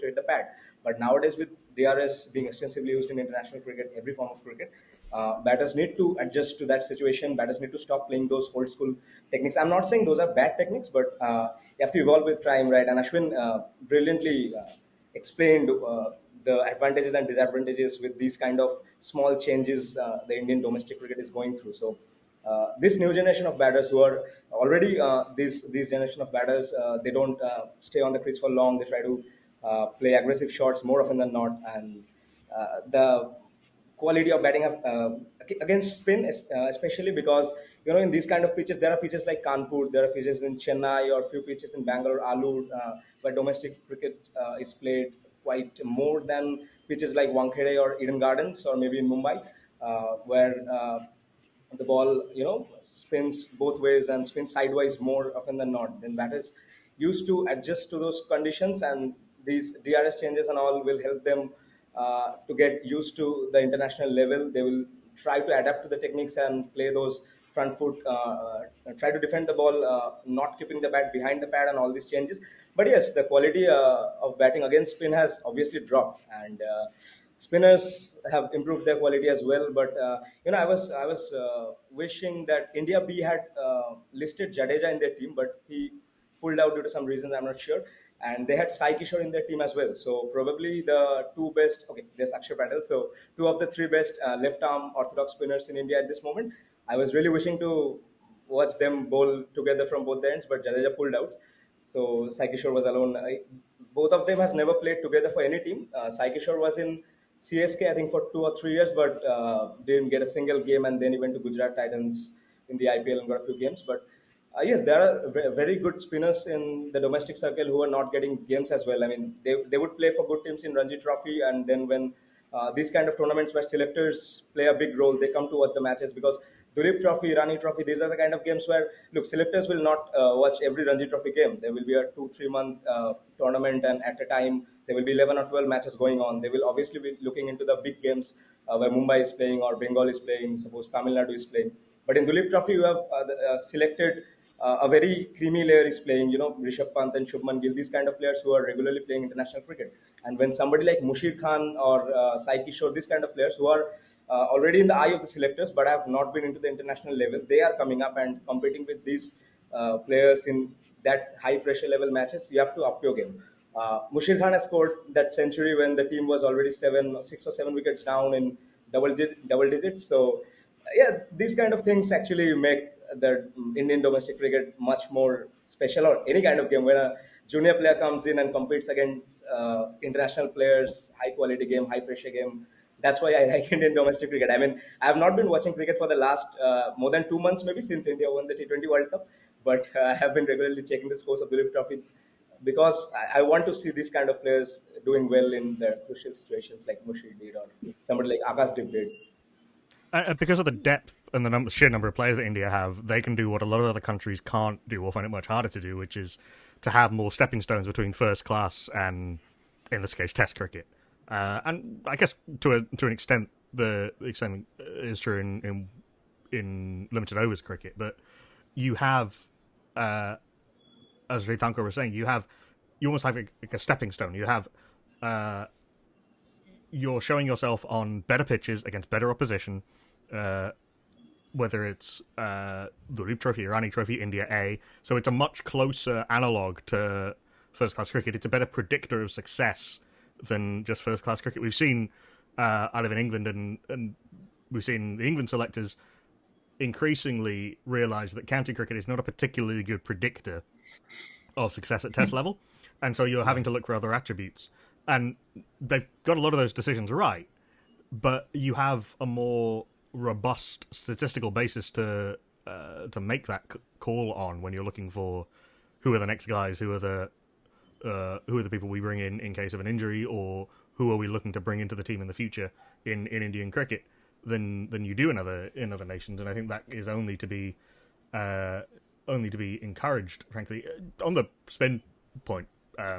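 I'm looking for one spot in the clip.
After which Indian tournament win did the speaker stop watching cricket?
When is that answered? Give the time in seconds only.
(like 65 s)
188 s.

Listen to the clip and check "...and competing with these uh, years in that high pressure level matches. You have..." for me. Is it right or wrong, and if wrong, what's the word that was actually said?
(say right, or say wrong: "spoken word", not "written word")
wrong: "players", not "years".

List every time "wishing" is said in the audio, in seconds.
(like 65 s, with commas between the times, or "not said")
81 s, 97 s.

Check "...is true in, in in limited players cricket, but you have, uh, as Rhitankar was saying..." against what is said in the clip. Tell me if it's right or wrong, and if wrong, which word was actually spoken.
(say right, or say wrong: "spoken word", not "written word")
wrong: "overs", not "players".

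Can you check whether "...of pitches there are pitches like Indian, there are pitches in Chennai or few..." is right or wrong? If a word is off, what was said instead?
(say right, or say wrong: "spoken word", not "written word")
wrong: "Kanpur", not "Indian".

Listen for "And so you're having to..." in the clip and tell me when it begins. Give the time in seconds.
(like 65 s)
253 s.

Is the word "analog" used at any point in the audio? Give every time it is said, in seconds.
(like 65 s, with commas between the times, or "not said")
236 s.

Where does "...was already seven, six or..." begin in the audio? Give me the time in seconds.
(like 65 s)
166 s.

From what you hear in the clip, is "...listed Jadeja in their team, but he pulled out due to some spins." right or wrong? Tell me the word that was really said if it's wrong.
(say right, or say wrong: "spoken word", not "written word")
wrong: "reasons", not "spins".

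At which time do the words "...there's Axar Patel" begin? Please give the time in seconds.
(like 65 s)
92 s.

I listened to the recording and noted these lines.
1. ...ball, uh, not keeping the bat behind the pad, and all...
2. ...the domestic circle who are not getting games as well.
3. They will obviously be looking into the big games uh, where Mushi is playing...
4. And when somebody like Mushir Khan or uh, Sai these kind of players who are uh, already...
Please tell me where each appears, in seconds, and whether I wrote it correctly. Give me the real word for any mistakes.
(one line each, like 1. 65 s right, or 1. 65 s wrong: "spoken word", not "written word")
1. 69 s right
2. 116 s right
3. 136 s wrong: "Mumbai", not "Mushi"
4. 150 s right.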